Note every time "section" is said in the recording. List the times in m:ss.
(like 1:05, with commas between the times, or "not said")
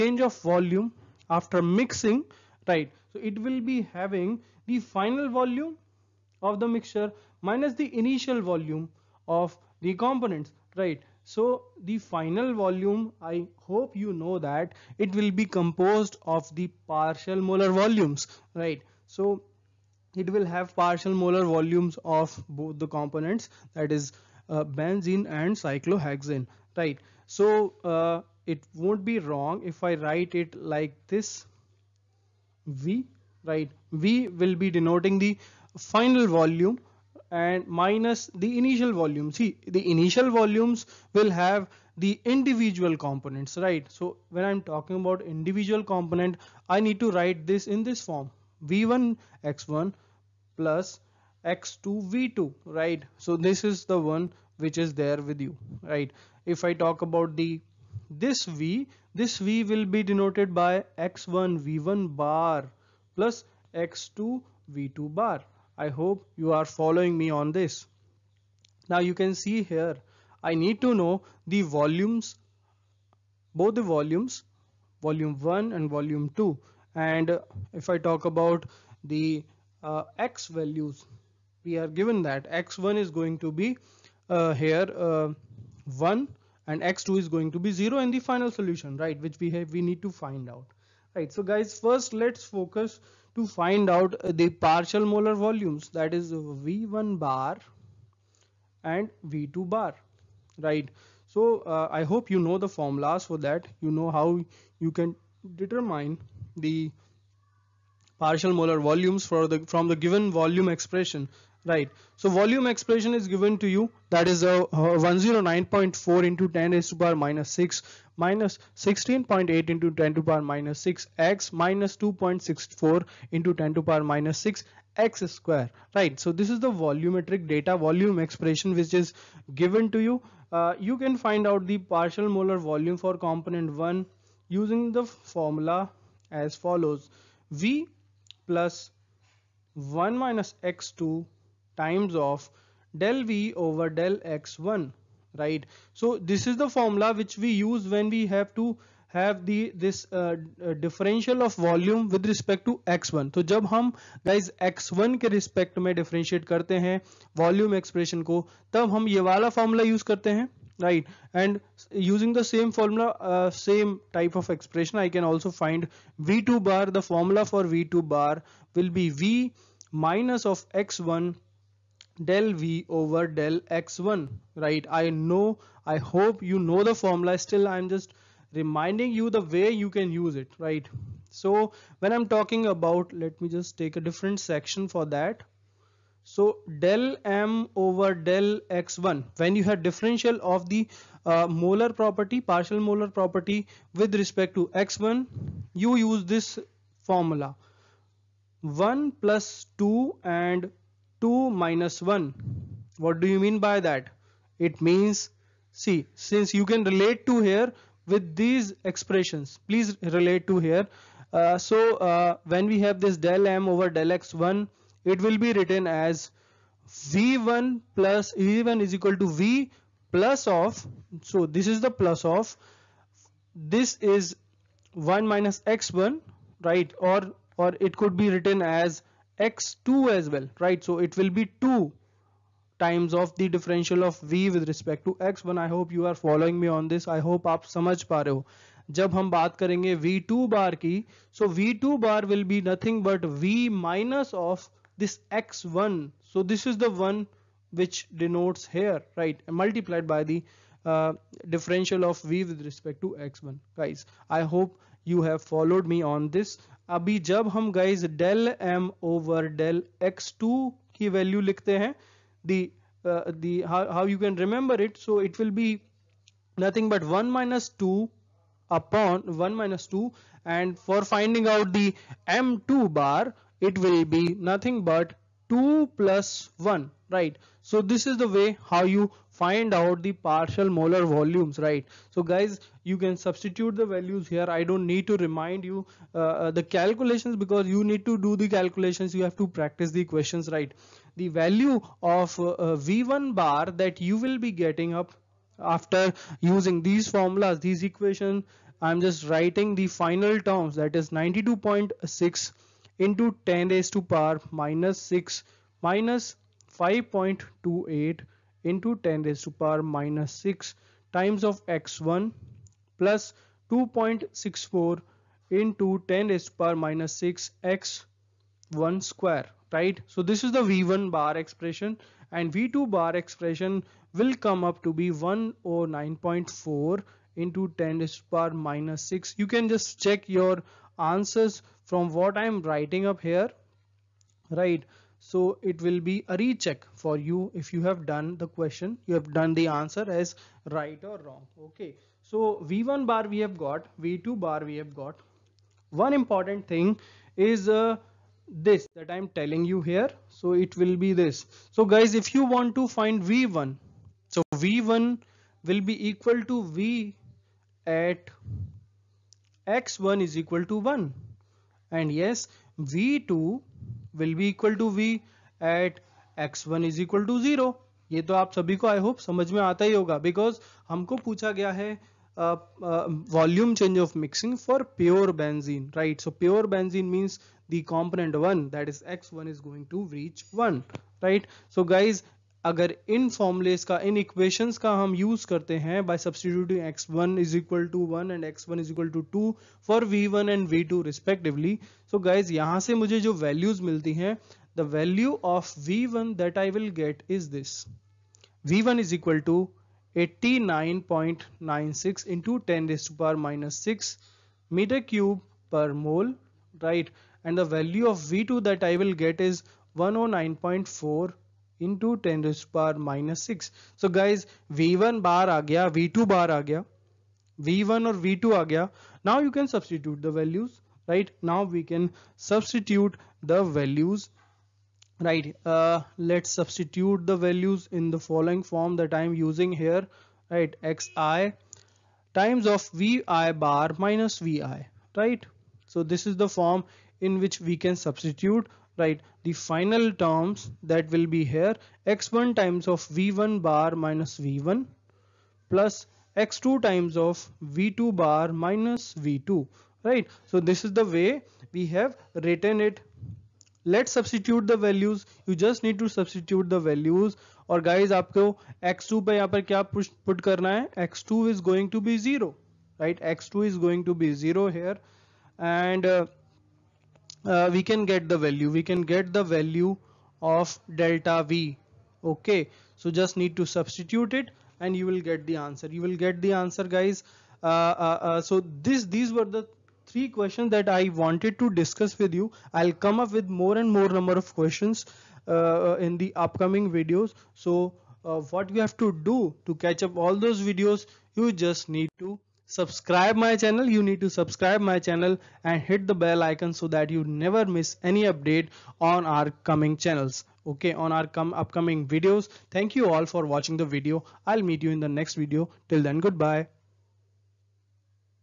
3:04.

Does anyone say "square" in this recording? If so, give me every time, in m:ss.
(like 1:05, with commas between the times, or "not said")
2:05, 5:19.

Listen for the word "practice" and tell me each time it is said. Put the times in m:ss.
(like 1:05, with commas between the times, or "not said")
4:49.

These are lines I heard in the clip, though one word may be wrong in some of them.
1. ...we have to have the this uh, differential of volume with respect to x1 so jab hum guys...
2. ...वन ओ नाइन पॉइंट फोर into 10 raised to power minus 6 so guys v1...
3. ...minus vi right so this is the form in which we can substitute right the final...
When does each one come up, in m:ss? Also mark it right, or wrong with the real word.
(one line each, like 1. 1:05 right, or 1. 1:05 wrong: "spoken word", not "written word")
1. 2:28 right
2. 6:49 right
3. 7:14 right.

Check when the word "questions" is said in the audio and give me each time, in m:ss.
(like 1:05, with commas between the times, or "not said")
4:50, 5:38, 8:00, 8:04.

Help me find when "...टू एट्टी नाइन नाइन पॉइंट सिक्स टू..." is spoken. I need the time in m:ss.
6:39.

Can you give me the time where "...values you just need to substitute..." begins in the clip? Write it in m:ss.
7:34.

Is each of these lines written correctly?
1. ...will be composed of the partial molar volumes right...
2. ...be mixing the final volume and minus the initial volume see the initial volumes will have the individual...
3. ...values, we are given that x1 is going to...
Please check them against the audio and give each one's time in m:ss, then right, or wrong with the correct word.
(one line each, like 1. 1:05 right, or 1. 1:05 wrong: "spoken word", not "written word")
1. 0:15 right
2. 0:34 wrong: "denoting", not "mixing"
3. 1:20 right.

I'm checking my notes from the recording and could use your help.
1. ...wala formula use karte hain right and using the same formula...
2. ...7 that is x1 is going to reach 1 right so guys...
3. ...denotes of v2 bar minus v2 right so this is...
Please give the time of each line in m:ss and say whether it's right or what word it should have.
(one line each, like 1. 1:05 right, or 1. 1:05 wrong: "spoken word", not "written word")
1. 2:39 right
2. 6:18 wrong: "1", not "7"
3. 7:26 wrong: "times", not "denotes".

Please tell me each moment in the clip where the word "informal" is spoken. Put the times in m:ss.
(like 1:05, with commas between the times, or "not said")
not said.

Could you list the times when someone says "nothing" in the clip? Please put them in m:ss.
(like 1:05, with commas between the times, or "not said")
4:02, 4:26, 4:34.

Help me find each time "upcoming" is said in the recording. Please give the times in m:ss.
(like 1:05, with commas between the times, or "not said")
8:06, 8:21.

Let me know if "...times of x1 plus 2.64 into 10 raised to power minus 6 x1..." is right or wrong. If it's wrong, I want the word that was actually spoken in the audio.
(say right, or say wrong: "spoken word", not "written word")
right.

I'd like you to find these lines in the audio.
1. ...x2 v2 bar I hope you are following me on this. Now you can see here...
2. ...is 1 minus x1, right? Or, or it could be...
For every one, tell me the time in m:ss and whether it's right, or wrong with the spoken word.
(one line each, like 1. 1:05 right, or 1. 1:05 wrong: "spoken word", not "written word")
1. 1:03 right
2. 3:44 right.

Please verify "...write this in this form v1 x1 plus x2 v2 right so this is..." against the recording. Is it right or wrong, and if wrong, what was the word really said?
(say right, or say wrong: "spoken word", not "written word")
right.